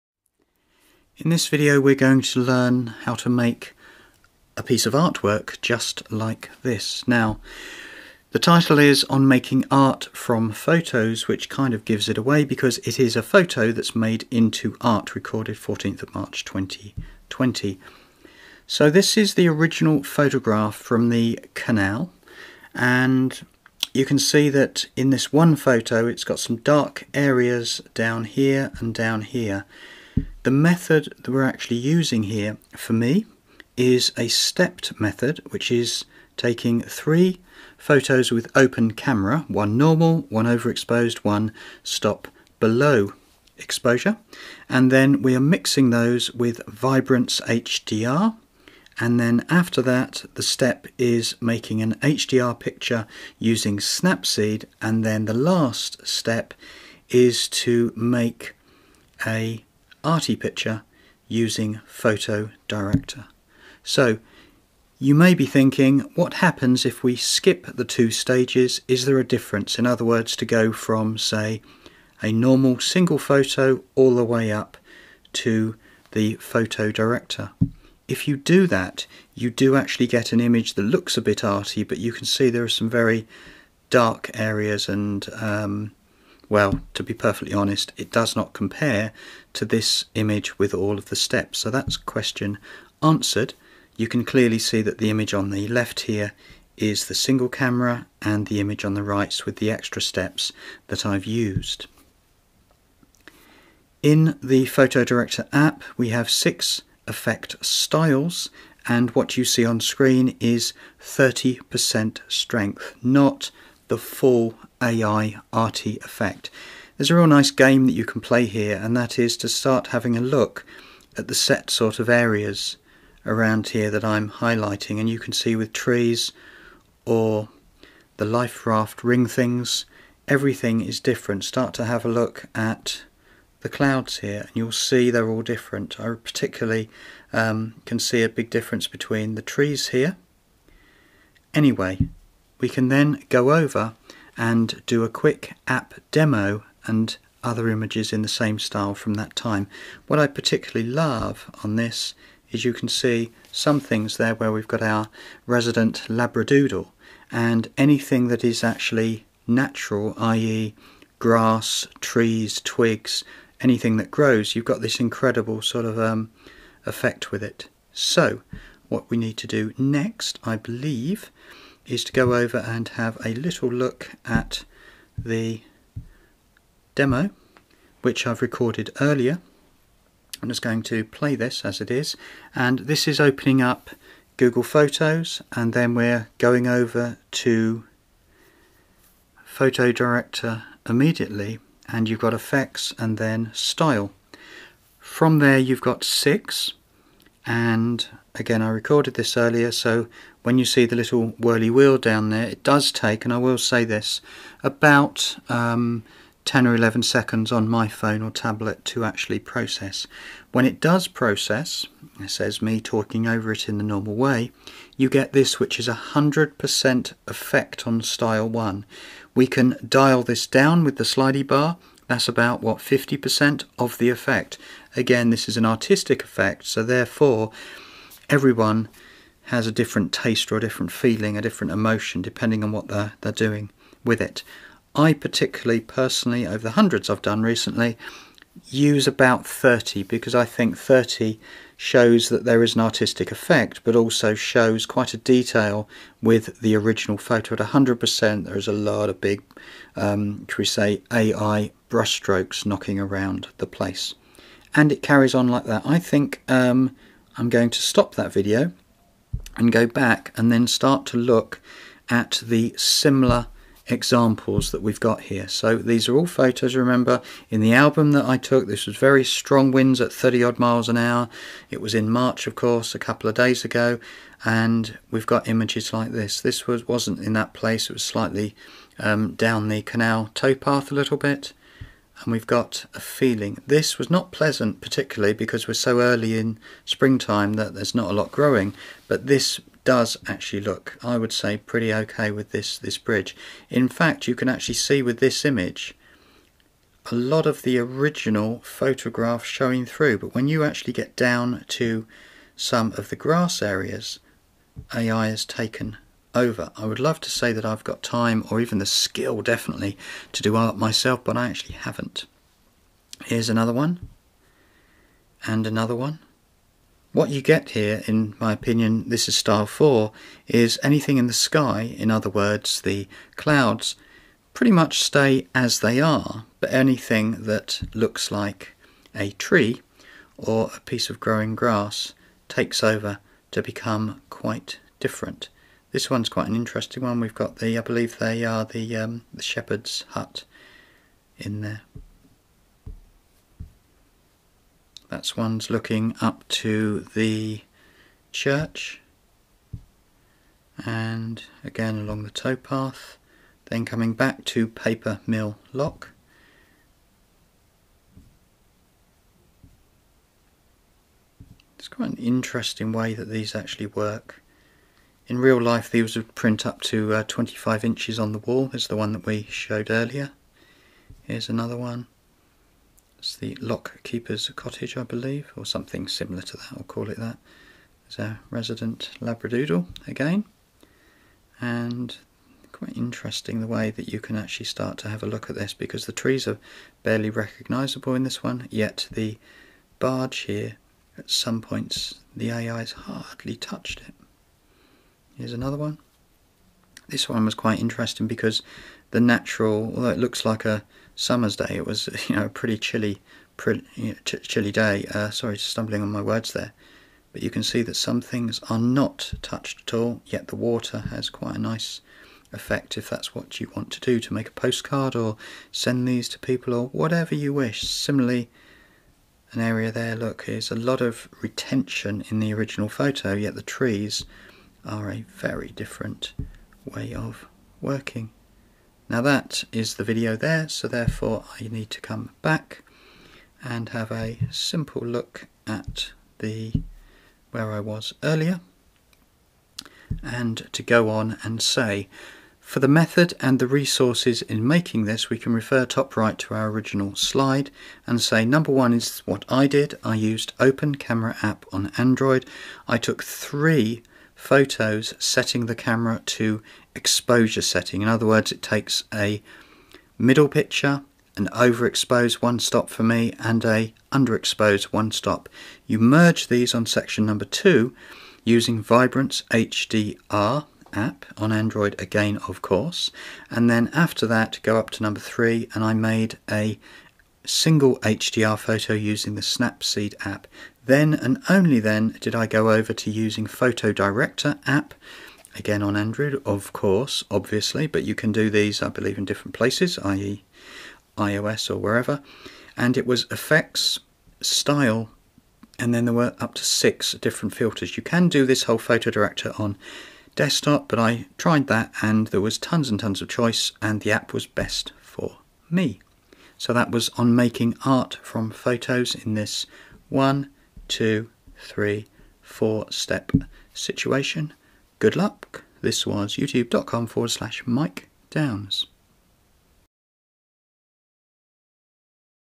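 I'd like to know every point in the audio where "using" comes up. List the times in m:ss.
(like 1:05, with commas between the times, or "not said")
0:31, 0:53, 1:01, 7:48, 7:58, 8:03.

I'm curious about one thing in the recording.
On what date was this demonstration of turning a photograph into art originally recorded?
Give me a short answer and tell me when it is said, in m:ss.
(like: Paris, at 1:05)
14 March 2020, at 0:15.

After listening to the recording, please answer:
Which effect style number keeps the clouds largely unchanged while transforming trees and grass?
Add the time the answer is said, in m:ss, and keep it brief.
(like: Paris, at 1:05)
Style 4, at 5:19.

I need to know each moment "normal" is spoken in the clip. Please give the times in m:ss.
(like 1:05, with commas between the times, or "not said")
0:39, 1:12, 3:33.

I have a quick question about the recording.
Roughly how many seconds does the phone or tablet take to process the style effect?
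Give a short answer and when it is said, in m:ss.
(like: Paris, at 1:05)
10 or 11 seconds, at 3:26.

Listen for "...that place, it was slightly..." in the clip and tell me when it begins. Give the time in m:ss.
4:37.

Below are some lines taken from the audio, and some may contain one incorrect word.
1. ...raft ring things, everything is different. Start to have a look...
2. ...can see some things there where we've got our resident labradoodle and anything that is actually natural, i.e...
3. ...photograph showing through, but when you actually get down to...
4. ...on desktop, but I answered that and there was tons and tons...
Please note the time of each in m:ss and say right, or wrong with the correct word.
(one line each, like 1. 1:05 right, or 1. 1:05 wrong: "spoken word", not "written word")
1. 2:08 right
2. 2:32 right
3. 4:58 right
4. 8:19 wrong: "tried", not "answered".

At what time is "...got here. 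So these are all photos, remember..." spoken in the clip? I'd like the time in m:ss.
4:24.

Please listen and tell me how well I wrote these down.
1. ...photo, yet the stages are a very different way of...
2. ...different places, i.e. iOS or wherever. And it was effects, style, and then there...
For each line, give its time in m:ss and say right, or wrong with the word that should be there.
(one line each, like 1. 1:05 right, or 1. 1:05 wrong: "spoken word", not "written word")
1. 7:02 wrong: "trees", not "stages"
2. 8:09 right.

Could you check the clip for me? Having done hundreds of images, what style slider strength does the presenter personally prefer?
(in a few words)
30.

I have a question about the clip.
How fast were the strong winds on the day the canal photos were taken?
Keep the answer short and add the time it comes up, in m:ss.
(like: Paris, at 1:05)
30 miles an hour, at 4:30.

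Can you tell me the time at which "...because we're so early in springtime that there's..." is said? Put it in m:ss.
4:45.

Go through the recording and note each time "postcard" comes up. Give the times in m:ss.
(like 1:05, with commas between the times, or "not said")
6:54.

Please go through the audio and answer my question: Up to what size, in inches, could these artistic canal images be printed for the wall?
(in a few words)
25 inches.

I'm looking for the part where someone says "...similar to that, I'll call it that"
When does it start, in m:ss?
6:16.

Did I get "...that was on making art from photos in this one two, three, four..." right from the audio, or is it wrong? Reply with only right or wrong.
right.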